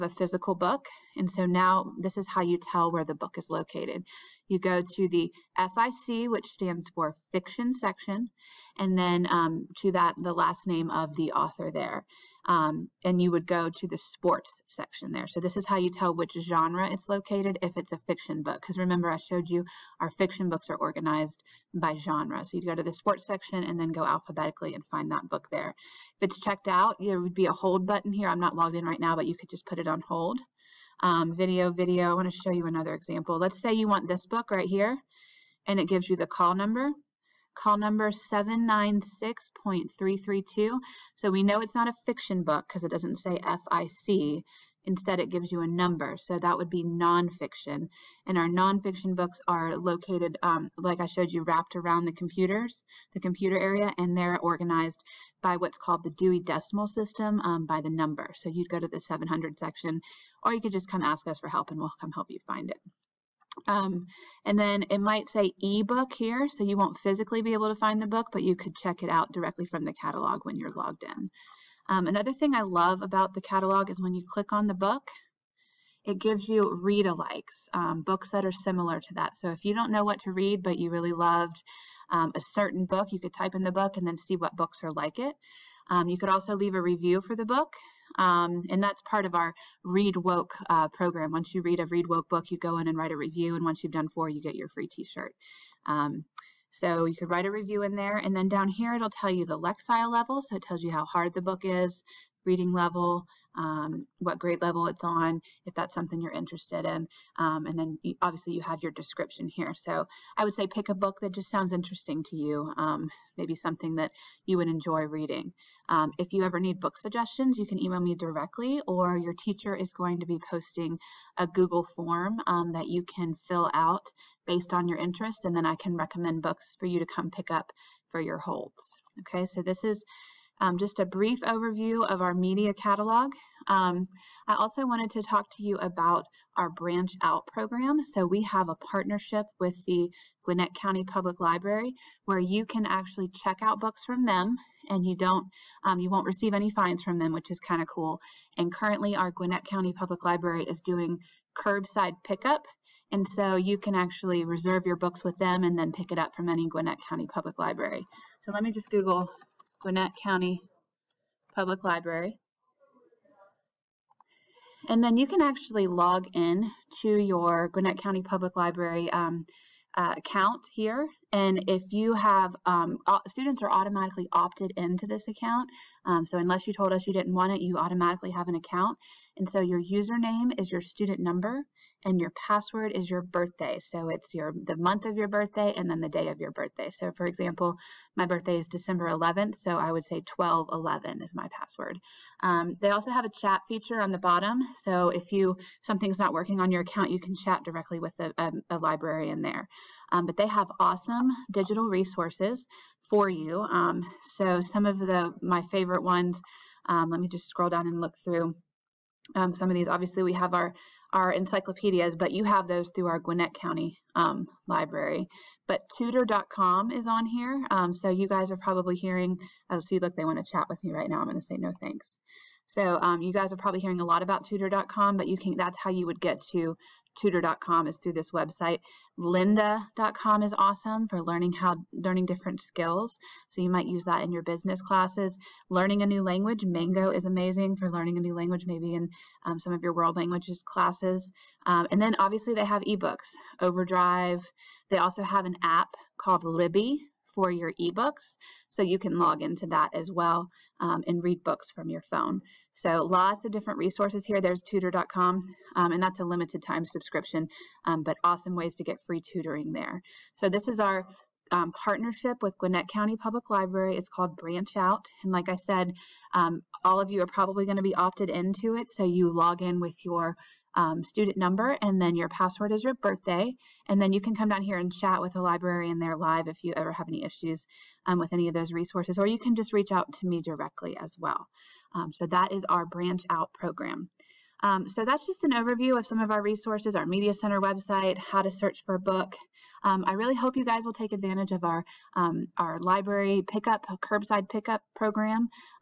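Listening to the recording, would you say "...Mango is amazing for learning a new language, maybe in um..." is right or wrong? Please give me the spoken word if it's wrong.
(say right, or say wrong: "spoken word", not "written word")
right.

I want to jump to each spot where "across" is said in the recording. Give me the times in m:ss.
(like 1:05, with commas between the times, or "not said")
not said.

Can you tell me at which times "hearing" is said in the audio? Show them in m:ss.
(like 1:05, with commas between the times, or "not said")
3:38, 3:43.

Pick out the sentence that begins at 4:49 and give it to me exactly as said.
Um, I really hope you guys will take advantage of our um, our library pickup, curbside pickup program.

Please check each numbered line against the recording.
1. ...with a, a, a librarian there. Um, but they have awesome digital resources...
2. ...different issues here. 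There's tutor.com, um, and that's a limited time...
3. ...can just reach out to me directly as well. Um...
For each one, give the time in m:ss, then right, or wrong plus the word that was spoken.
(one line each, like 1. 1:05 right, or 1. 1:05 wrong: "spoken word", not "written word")
1. 3:17 right
2. 4:13 wrong: "resources", not "issues"
3. 4:39 right.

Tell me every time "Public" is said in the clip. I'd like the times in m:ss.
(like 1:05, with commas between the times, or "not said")
2:21, 2:29, 2:37, 2:41, 2:48, 4:23.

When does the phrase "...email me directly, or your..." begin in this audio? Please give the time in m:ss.
1:57.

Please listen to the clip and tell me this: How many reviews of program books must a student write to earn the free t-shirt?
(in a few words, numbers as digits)
4.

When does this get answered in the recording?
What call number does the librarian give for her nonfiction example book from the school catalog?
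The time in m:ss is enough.
0:38.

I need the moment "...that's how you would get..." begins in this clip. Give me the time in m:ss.
3:45.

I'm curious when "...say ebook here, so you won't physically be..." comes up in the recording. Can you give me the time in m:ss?
1:05.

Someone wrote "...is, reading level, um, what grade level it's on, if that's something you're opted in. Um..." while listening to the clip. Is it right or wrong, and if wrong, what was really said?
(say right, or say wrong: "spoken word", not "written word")
wrong: "interested", not "opted".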